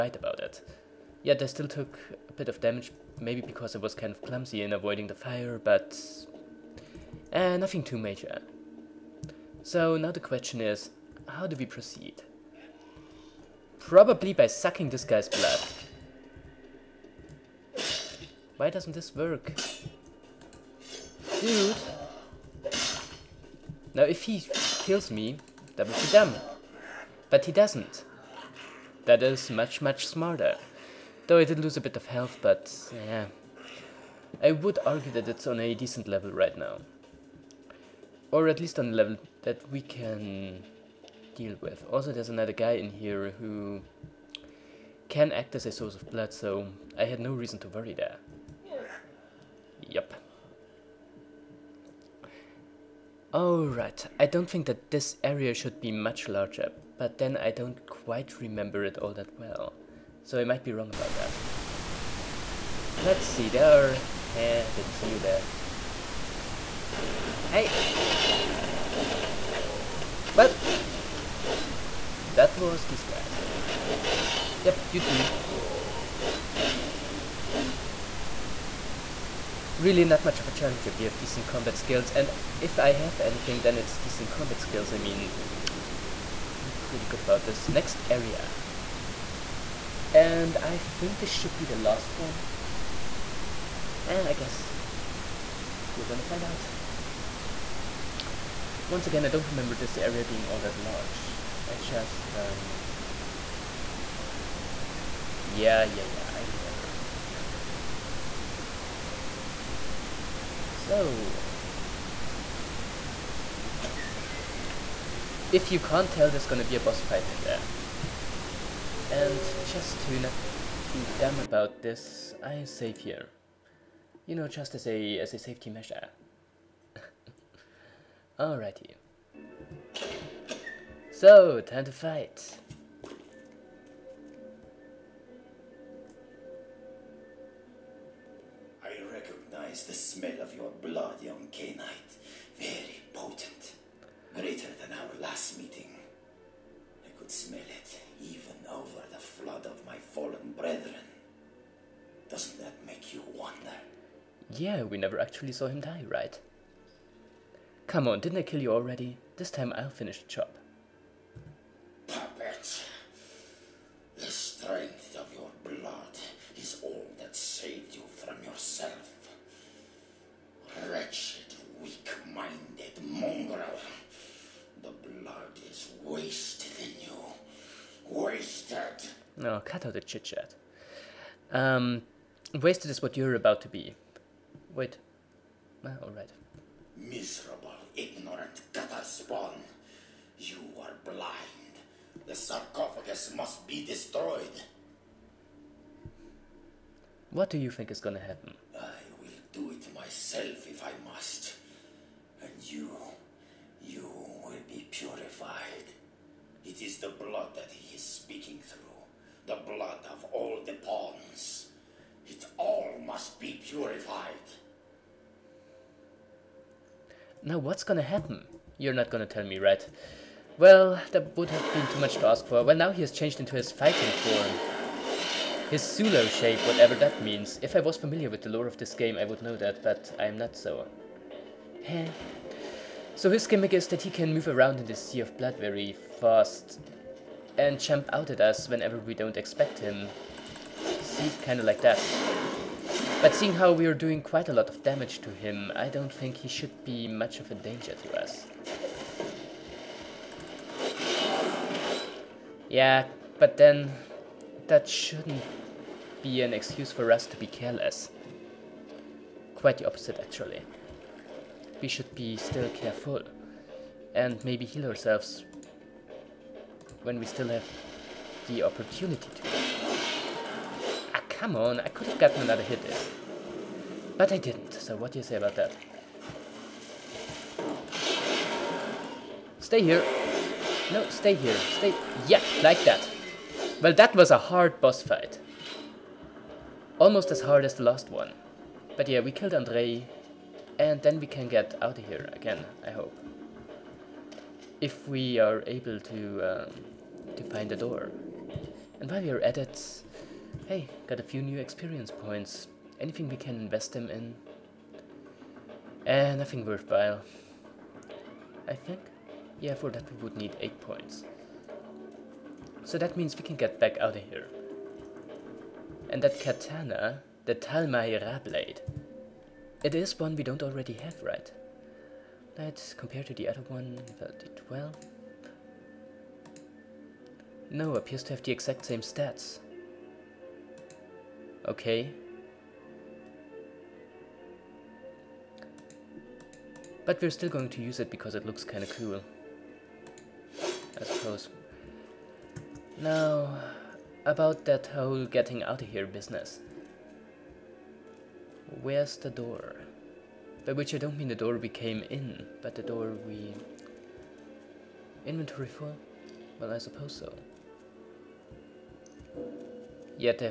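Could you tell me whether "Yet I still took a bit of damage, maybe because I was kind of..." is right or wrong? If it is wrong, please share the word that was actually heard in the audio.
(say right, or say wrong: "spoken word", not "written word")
right.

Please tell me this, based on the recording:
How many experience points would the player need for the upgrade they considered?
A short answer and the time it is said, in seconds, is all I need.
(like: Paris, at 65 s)
8, at 310 s.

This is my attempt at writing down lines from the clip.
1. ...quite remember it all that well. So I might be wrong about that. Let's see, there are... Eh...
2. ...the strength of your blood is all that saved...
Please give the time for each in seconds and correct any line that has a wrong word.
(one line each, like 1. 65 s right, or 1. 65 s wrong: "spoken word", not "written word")
1. 57 s right
2. 164 s right.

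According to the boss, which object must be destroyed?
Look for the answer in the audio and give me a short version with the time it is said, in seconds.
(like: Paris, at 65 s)
The sarcophagus, at 192 s.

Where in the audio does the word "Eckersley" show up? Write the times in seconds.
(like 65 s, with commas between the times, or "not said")
not said.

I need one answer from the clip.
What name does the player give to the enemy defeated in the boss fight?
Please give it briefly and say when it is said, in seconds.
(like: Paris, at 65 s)
Andrei, at 289 s.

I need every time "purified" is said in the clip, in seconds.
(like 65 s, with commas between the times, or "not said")
204 s, 213 s.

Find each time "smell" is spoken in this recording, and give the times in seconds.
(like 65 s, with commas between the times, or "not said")
139 s, 147 s.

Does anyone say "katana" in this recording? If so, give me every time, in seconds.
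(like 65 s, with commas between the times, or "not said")
316 s.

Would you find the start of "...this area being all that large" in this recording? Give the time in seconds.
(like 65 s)
99 s.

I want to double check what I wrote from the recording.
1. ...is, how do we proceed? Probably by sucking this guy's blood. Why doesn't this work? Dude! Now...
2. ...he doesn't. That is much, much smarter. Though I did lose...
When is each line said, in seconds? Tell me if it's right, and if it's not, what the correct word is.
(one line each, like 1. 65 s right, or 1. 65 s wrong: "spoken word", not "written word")
1. 10 s right
2. 27 s right.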